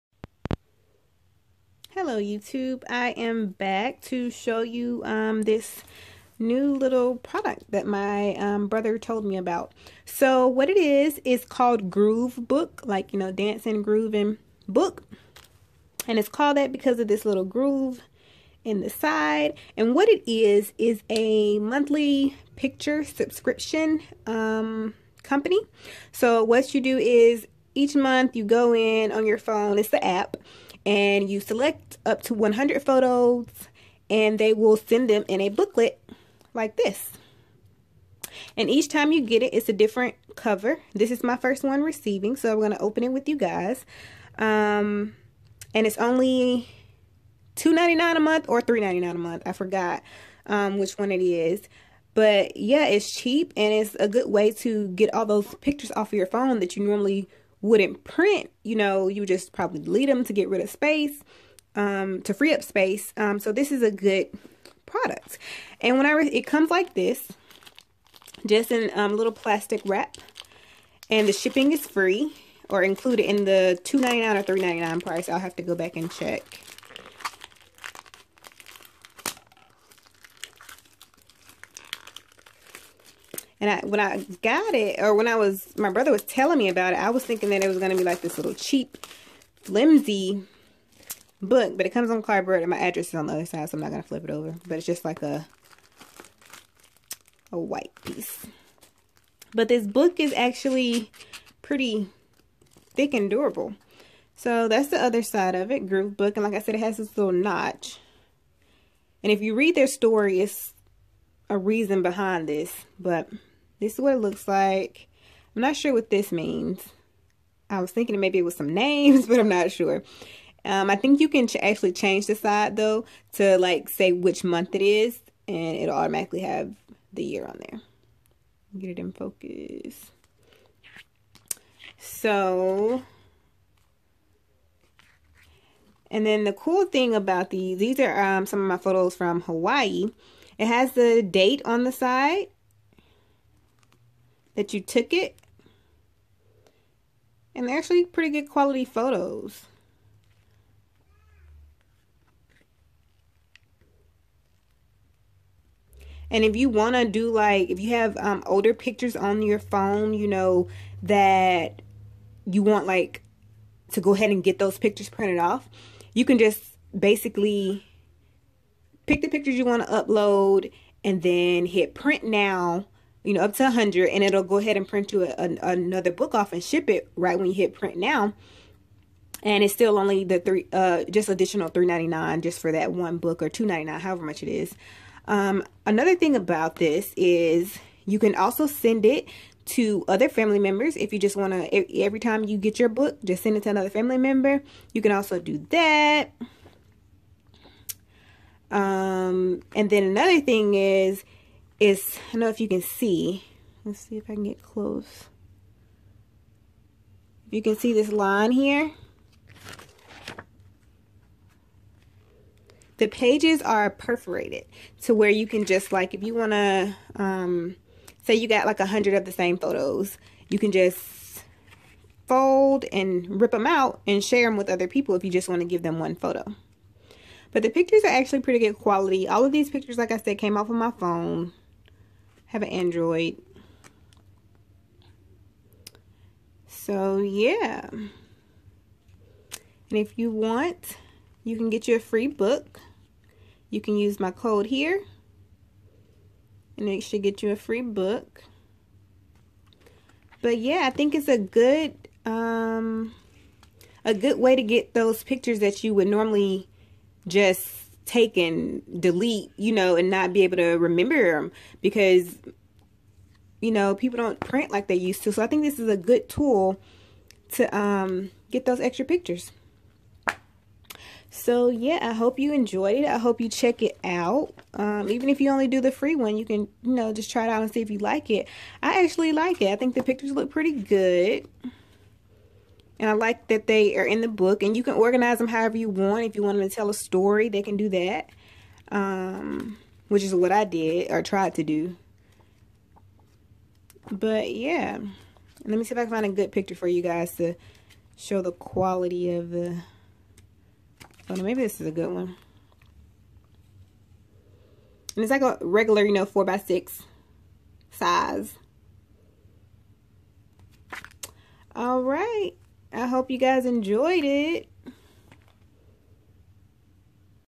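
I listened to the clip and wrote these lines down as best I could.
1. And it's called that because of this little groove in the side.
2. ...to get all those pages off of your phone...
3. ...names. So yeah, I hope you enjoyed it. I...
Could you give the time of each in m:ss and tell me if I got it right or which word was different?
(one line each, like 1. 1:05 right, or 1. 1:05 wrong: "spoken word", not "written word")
1. 0:16 right
2. 0:54 wrong: "pictures", not "pages"
3. 4:29 wrong: "pictures", not "names".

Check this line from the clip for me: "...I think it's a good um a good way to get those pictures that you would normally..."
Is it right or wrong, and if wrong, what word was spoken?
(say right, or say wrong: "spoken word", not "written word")
right.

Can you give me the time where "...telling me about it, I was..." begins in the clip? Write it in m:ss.
1:26.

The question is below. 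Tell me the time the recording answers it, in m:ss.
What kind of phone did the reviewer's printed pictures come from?
3:52.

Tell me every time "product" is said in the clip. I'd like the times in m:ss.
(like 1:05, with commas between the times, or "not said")
0:07, 1:04.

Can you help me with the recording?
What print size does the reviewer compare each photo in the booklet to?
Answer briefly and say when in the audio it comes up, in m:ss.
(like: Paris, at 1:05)
4 by 6, at 5:06.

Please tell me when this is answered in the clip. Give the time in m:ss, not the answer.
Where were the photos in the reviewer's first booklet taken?
2:19.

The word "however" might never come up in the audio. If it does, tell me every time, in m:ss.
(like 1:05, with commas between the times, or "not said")
3:03, 4:45.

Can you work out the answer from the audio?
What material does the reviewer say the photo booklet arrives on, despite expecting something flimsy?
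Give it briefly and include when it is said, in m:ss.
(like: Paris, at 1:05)
Cardboard, at 1:32.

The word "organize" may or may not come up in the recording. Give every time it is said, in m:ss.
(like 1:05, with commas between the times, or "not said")
4:44.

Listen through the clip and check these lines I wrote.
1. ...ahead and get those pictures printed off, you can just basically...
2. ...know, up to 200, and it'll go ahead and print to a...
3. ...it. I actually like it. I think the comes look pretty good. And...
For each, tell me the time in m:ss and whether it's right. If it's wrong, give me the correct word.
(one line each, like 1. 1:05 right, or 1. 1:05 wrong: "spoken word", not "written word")
1. 2:44 right
2. 2:53 wrong: "100", not "200"
3. 4:38 wrong: "pictures", not "comes".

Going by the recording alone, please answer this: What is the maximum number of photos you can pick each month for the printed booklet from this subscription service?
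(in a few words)
100.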